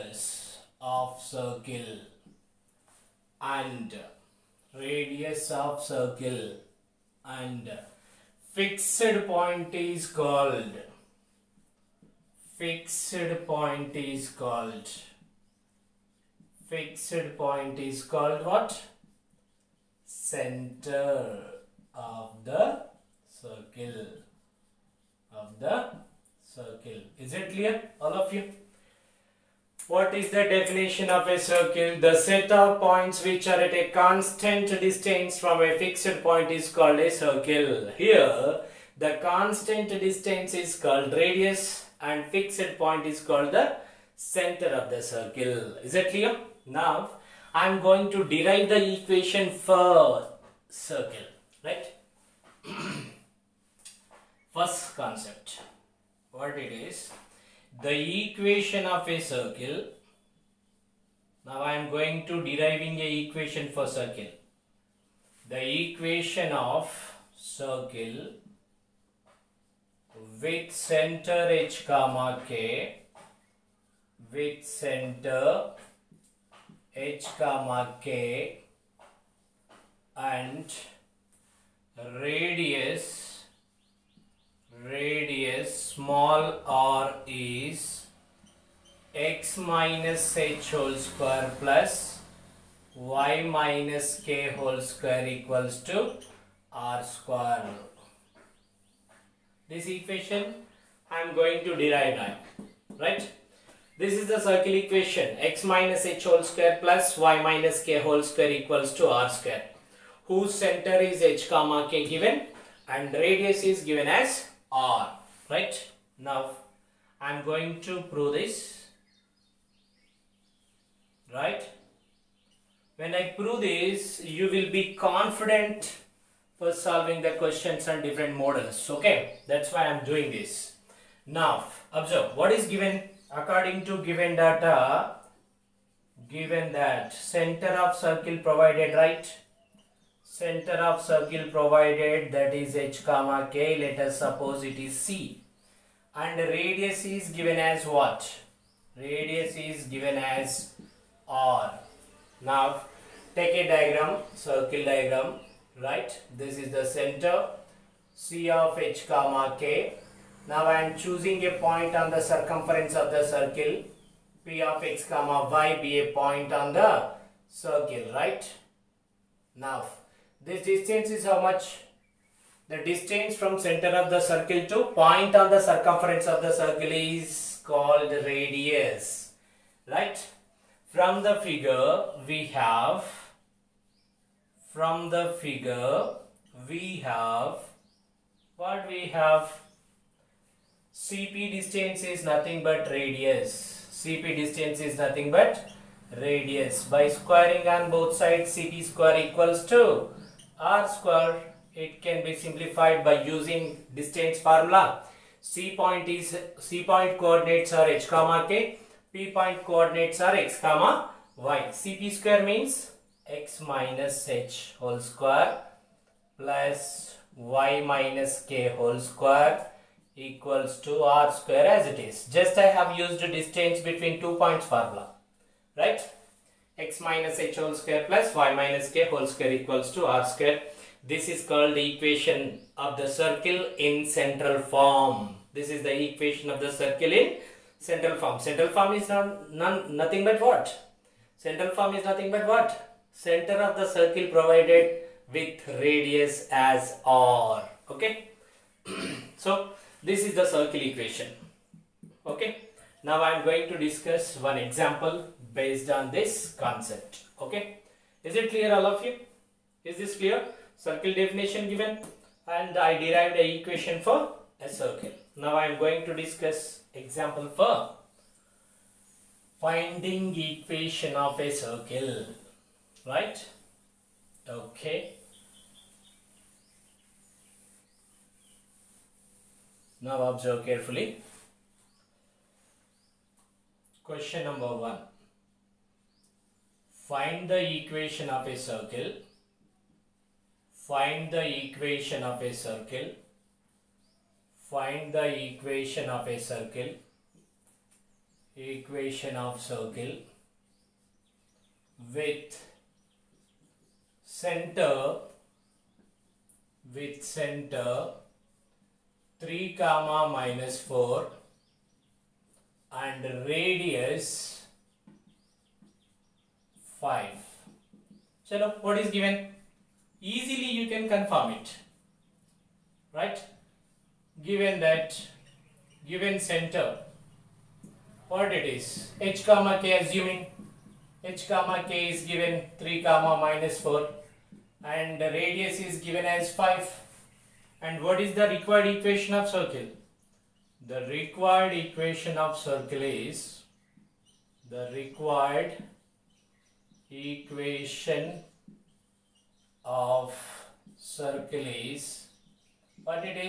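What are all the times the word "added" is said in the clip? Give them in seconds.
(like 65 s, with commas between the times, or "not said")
not said.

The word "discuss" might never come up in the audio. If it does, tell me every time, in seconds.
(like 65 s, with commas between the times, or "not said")
253 s, 266 s.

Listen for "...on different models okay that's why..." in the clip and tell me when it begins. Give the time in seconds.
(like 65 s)
127 s.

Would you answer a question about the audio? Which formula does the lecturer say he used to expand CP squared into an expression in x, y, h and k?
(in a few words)
distance between two points formula.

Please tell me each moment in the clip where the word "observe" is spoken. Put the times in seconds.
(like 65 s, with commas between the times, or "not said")
131 s, 280 s.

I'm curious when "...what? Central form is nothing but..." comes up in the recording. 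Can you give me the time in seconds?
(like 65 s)
240 s.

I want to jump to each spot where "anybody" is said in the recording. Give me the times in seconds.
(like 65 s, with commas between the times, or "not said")
not said.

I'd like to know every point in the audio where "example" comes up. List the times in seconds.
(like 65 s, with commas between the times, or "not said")
254 s, 266 s.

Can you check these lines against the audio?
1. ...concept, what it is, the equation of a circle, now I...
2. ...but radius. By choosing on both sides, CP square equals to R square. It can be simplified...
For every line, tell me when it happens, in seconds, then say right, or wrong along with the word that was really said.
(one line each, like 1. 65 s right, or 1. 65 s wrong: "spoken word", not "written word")
1. 54 s right
2. 195 s wrong: "squaring", not "choosing".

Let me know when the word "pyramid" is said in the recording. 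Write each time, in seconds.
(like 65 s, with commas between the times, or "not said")
not said.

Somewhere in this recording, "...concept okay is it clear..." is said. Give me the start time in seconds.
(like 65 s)
256 s.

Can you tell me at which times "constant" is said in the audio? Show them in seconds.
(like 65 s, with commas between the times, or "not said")
33 s, 39 s.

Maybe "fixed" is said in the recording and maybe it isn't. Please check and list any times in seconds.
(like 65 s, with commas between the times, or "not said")
8 s, 12 s, 16 s, 35 s, 42 s.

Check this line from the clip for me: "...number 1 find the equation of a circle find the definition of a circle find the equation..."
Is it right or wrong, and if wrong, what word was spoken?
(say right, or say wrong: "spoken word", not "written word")
wrong: "equation", not "definition".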